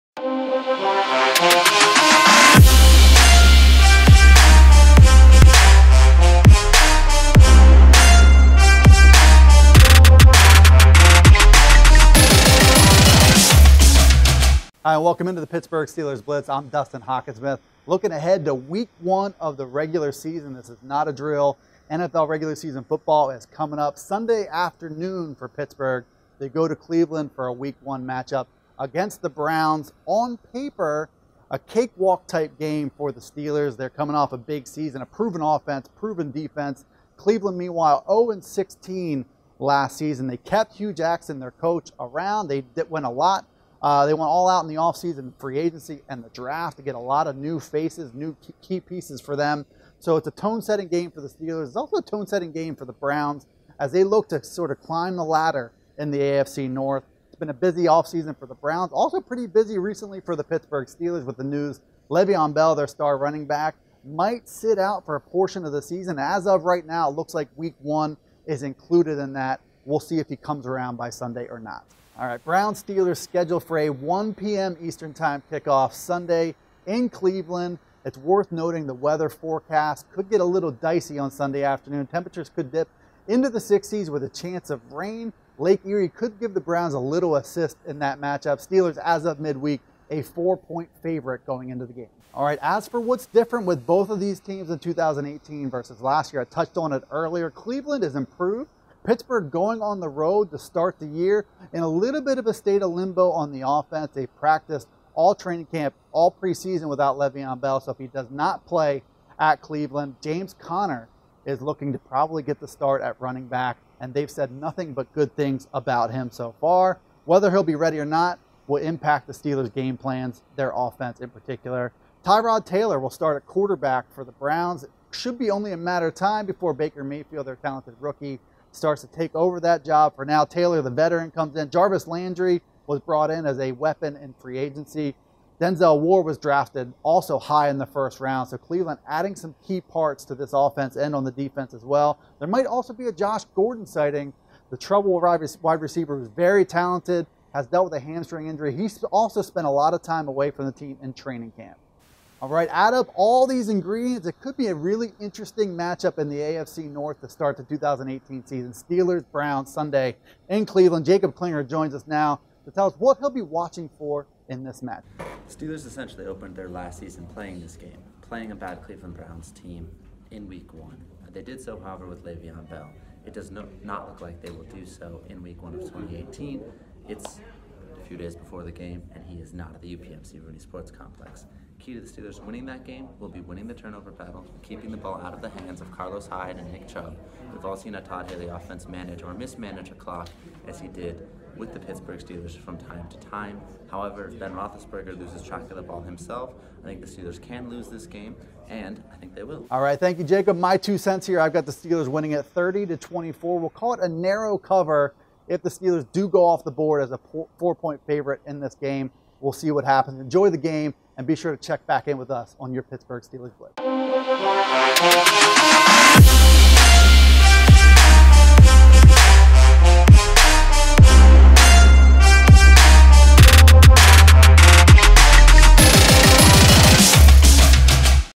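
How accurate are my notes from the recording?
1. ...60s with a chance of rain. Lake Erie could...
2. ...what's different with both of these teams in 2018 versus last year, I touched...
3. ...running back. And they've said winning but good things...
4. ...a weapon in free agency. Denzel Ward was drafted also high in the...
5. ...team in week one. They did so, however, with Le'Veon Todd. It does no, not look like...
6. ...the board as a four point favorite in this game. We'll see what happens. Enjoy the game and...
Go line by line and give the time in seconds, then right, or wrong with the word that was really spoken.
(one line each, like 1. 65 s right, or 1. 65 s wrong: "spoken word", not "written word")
1. 83 s right
2. 92 s right
3. 113 s wrong: "nothing", not "winning"
4. 133 s right
5. 169 s wrong: "Bell", not "Todd"
6. 206 s right.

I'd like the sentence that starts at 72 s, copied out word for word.
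All right, Brown Steelers scheduled for a 1 p.m.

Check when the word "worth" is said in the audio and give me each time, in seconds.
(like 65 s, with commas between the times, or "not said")
78 s.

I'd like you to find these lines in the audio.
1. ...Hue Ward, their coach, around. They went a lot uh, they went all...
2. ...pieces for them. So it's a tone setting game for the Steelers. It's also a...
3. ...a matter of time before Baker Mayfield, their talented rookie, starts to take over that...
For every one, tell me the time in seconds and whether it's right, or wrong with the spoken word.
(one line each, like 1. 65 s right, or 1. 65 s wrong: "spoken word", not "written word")
1. 40 s wrong: "Jackson", not "Ward"
2. 48 s right
3. 125 s right.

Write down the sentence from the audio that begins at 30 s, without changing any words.
On paper, a cakewalk type game for the Steelers.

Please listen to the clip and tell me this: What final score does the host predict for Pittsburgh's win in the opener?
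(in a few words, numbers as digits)
30 to 24.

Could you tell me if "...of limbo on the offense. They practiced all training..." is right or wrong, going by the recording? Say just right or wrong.
right.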